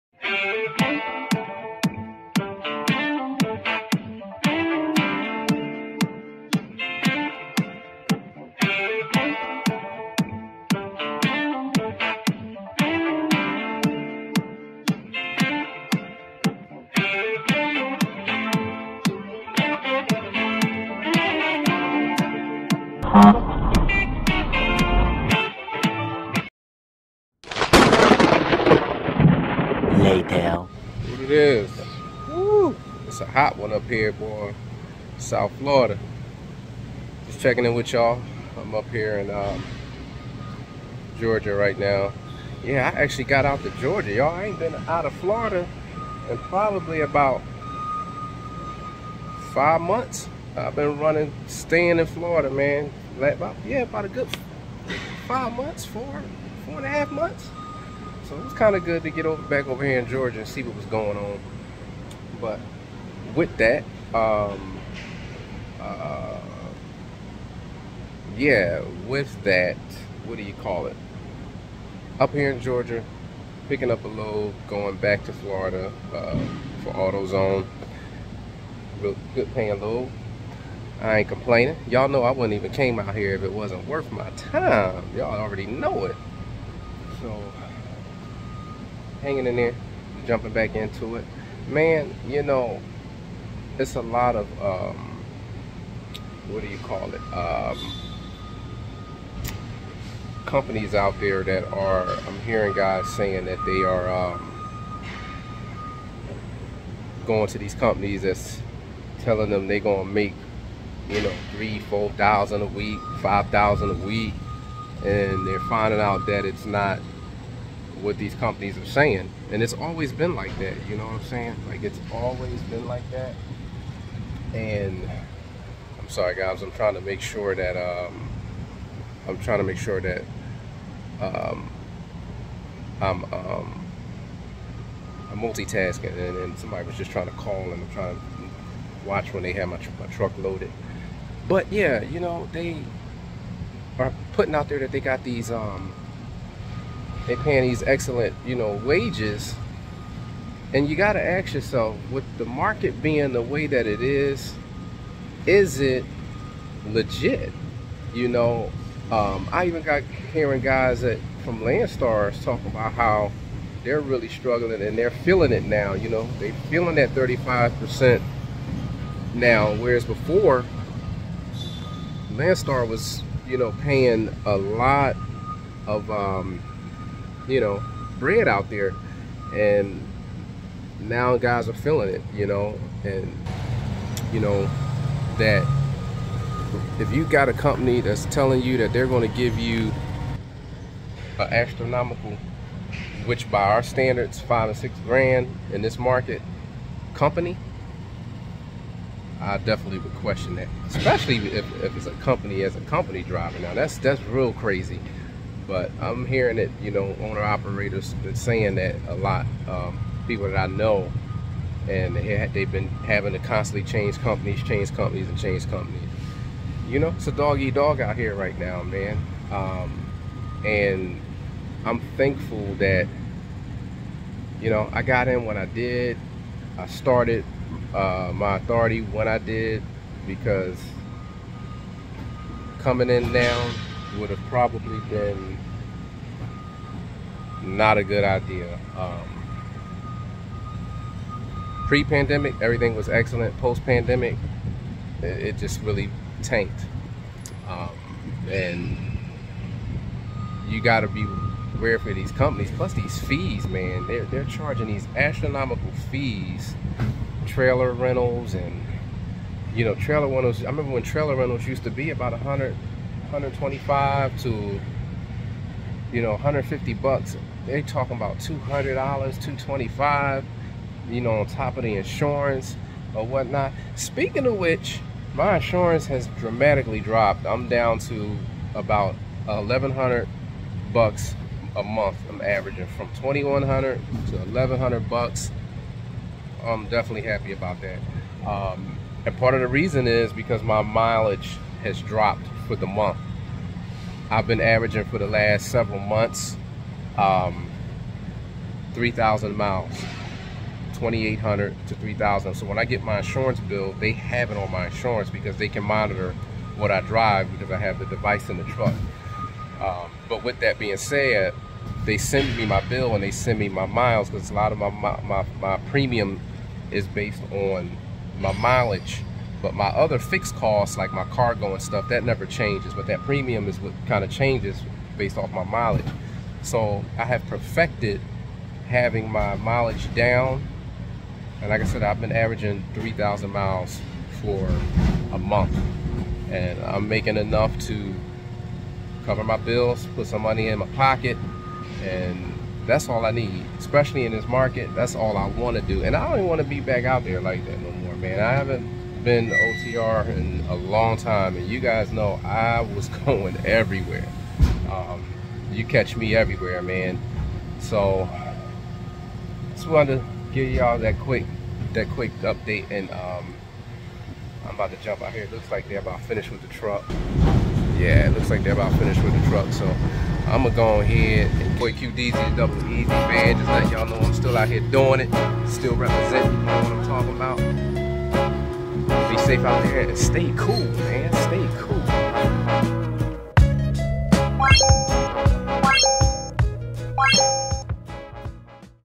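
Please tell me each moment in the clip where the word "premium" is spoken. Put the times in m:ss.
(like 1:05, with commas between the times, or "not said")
5:15, 5:23.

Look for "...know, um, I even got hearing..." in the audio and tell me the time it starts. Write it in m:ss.
2:38.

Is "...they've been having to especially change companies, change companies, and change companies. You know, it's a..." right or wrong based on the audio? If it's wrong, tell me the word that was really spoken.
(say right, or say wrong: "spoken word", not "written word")
wrong: "constantly", not "especially".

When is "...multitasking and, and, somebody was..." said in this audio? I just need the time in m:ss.
2:15.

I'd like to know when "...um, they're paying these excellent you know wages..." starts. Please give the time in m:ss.
2:25.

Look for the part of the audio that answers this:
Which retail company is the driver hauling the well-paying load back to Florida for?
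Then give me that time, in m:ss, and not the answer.
1:16.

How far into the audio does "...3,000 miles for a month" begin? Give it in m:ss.
5:32.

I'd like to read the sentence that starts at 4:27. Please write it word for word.
They're talking about $200, 225 you know, on top of the insurance or whatnot.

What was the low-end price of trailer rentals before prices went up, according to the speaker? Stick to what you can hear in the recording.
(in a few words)
100.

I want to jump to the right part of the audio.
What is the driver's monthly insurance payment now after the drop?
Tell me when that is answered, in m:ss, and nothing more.
4:39.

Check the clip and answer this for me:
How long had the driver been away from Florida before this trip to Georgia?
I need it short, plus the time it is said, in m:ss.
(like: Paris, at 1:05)
about five months, at 0:47.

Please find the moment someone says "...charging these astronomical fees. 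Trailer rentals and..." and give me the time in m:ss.
4:14.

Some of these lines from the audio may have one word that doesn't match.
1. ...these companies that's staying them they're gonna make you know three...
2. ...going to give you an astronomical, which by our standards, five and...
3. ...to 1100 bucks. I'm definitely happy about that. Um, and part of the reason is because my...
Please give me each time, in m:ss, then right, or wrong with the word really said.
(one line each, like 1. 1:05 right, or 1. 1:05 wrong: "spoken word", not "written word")
1. 1:47 wrong: "telling", not "staying"
2. 3:09 right
3. 4:43 right.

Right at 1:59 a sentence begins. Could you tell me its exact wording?
And it's always been like that, you know what I'm saying?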